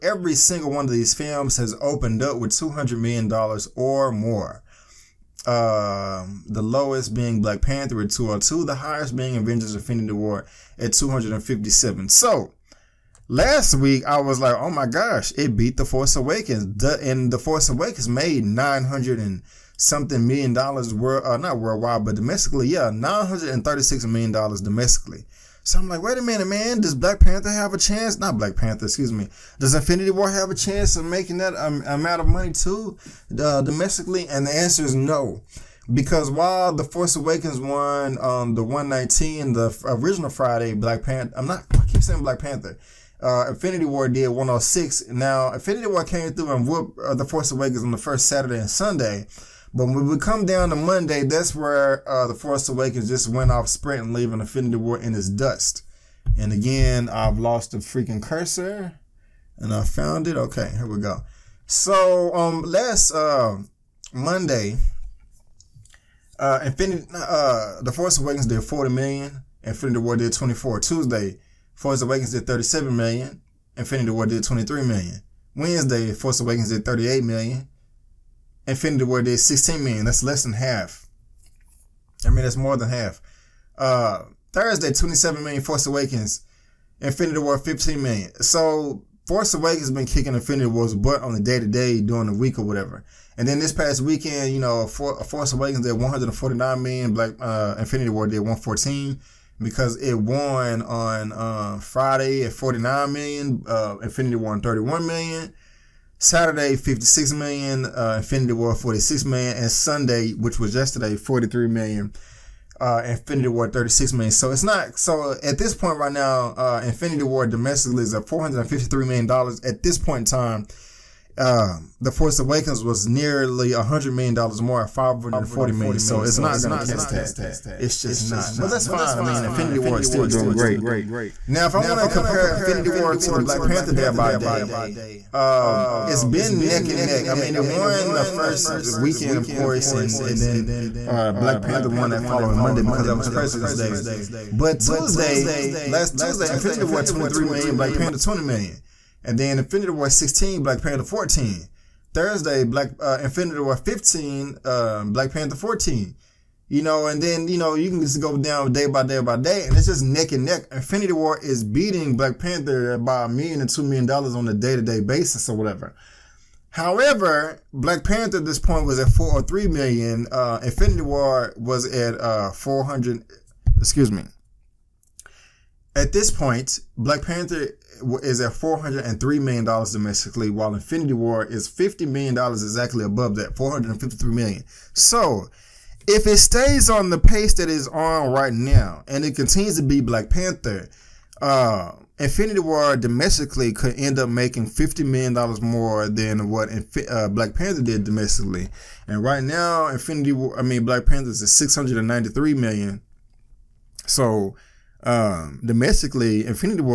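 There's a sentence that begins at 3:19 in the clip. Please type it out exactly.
And right now, Infinity War, I mean, Black Panther is $693 million.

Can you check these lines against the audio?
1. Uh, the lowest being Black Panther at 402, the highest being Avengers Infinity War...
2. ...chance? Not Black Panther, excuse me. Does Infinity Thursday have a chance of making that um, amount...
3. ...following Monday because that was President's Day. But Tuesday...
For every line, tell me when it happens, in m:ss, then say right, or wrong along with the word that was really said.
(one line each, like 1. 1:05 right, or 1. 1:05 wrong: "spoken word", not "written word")
1. 0:05 wrong: "202", not "402"
2. 0:27 wrong: "War", not "Thursday"
3. 2:22 right.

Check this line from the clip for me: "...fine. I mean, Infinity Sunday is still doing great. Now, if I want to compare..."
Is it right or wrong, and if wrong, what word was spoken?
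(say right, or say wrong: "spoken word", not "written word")
wrong: "War", not "Sunday".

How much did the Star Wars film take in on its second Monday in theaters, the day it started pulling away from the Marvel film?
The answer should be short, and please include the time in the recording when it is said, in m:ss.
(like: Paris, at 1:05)
40 million, at 1:08.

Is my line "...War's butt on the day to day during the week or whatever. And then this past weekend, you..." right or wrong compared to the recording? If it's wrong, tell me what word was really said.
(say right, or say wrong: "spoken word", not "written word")
right.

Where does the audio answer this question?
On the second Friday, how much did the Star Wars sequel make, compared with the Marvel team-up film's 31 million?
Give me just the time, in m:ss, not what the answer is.
1:42.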